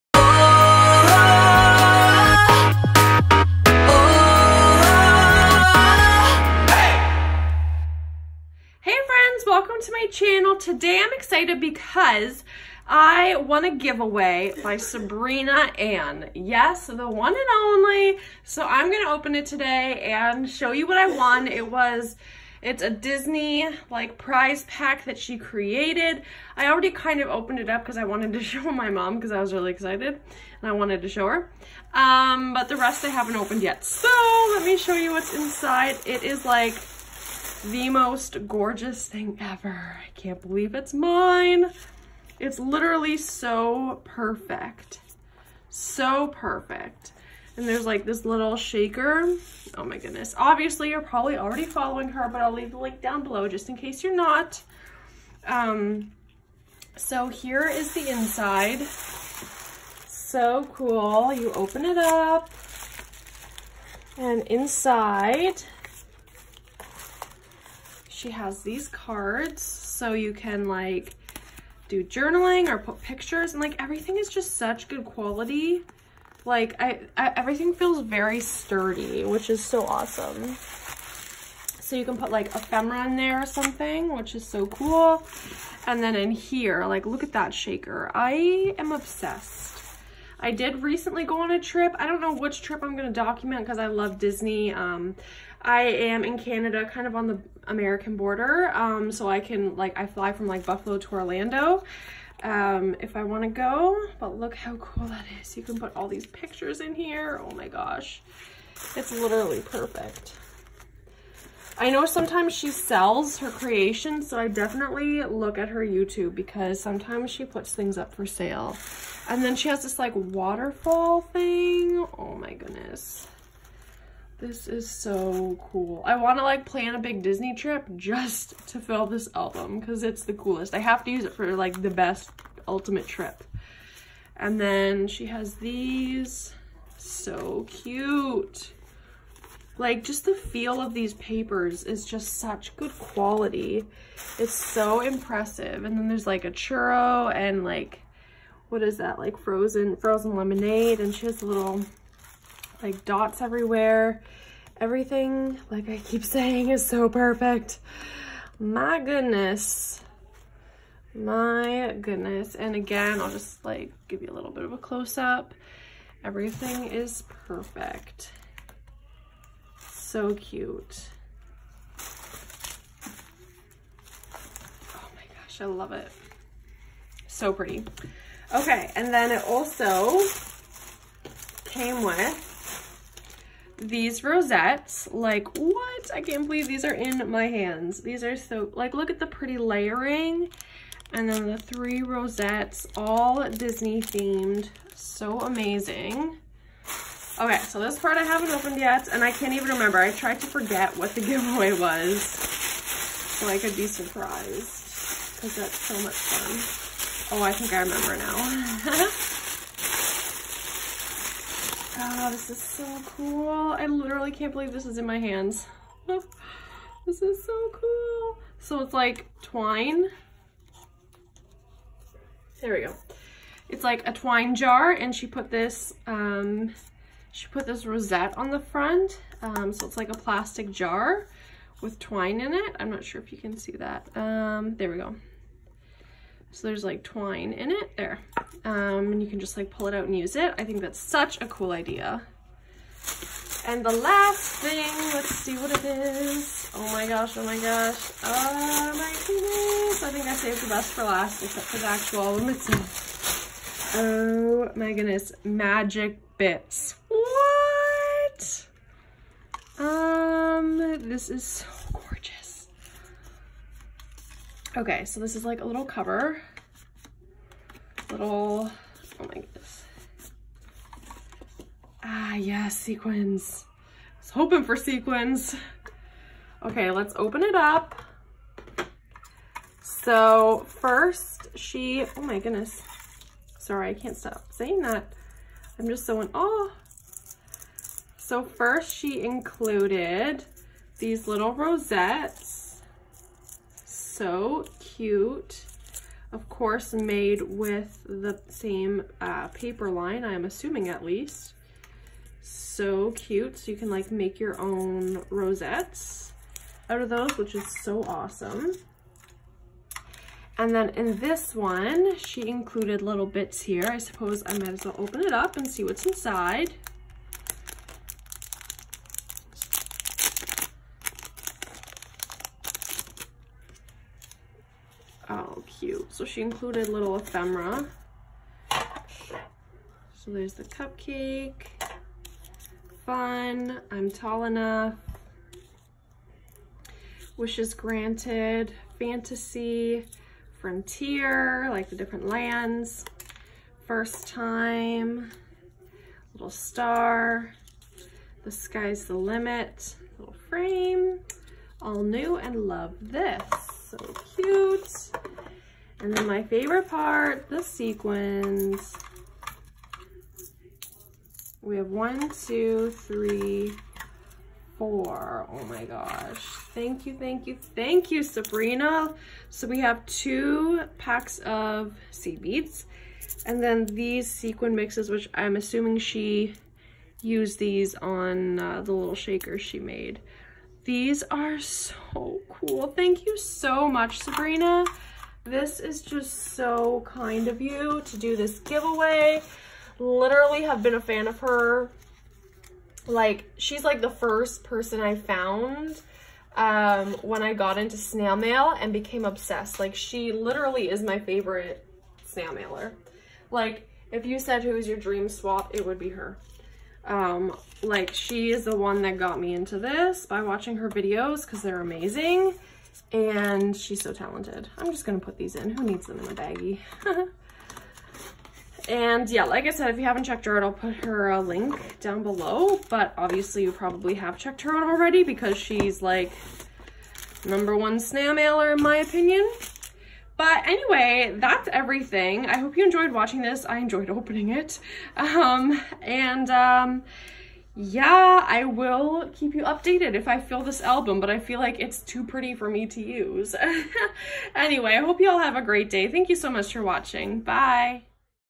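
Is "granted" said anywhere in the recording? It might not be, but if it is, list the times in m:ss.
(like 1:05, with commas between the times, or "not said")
5:37.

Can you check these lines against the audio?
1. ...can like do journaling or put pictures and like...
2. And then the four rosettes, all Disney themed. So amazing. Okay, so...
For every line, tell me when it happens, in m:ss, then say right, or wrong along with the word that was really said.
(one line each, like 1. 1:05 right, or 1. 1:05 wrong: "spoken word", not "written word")
1. 1:10 right
2. 3:11 wrong: "three", not "four".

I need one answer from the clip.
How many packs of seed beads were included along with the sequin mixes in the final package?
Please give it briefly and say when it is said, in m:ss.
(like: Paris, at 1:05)
2, at 6:10.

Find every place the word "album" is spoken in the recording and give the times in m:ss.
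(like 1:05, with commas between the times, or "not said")
2:09, 4:12, 7:20.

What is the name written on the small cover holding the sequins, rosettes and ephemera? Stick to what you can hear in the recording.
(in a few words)
Magic bits.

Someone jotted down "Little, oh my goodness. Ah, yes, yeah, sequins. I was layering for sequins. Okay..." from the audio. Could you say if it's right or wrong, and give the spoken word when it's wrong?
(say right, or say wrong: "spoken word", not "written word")
wrong: "hoping", not "layering".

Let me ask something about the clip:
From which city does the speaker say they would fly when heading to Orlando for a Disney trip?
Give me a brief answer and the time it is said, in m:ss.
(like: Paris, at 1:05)
Buffalo, at 1:40.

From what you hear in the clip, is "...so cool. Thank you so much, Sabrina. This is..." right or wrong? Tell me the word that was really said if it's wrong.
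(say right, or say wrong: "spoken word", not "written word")
right.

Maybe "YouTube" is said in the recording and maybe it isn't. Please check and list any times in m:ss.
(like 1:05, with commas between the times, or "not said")
1:55.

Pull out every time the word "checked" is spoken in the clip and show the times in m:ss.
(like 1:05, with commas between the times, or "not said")
7:00, 7:04.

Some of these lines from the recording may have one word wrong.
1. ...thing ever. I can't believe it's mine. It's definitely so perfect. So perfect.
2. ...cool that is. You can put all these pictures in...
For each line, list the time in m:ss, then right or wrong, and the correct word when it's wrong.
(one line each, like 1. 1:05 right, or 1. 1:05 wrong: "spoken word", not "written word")
1. 0:39 wrong: "literally", not "definitely"
2. 1:44 right.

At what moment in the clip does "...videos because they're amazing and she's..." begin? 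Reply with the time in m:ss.
6:50.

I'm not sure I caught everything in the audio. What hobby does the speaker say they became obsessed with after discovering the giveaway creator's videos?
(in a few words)
Snail mail.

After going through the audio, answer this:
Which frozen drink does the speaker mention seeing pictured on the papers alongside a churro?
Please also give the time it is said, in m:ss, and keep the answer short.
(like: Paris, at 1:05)
Frozen lemonade, at 2:29.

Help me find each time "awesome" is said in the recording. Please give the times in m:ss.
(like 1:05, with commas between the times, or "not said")
1:19, 5:08.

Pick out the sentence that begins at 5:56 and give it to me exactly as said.
And then my favorite part, the sequins.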